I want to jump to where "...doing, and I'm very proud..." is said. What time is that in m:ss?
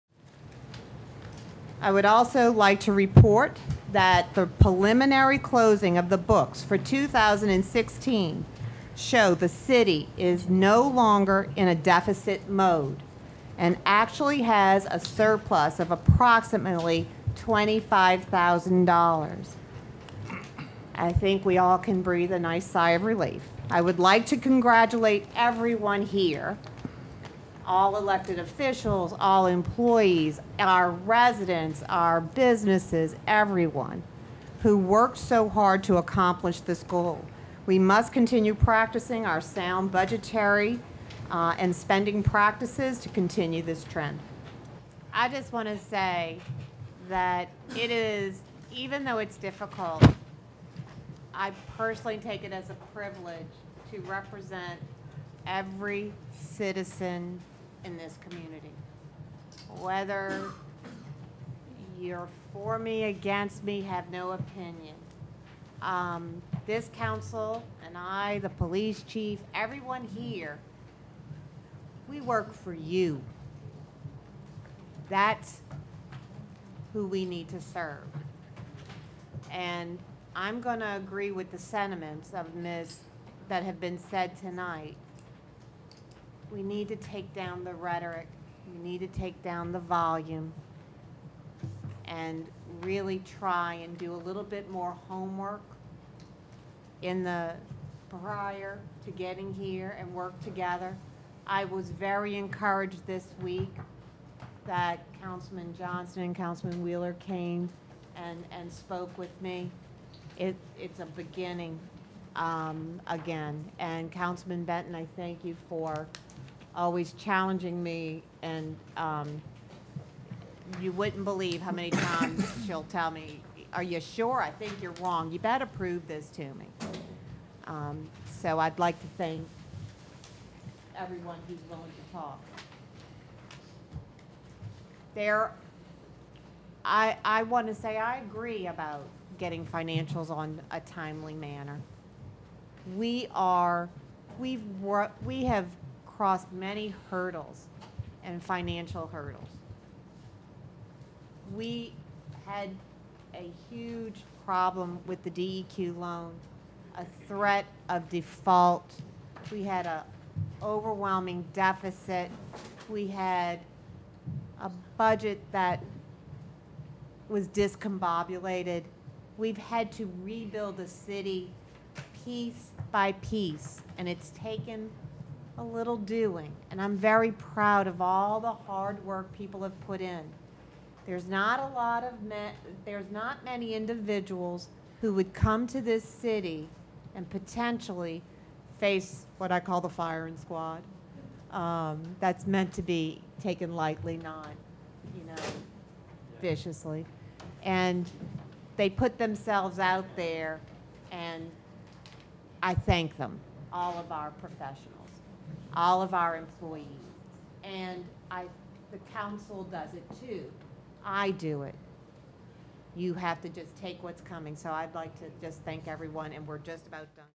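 2:55.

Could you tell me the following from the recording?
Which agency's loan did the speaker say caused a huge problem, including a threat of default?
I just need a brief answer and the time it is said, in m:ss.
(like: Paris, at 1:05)
DEQ, at 2:35.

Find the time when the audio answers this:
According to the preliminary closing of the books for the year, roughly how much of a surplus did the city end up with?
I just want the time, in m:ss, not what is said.
0:17.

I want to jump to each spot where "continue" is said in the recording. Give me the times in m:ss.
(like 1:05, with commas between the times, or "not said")
0:38, 0:43.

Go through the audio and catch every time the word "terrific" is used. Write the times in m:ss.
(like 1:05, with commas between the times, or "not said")
not said.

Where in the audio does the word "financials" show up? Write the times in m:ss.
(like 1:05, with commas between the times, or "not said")
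2:19, 2:28.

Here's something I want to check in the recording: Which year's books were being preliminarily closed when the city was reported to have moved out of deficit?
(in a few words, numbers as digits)
2016.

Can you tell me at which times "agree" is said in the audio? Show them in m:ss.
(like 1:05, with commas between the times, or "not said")
1:20, 2:18.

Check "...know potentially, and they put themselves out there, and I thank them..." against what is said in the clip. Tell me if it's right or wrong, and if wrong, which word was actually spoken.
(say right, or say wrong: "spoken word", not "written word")
wrong: "viciously", not "potentially".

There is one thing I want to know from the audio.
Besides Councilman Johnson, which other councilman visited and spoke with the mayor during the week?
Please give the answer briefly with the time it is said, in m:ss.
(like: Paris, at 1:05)
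Wheeler, at 1:46.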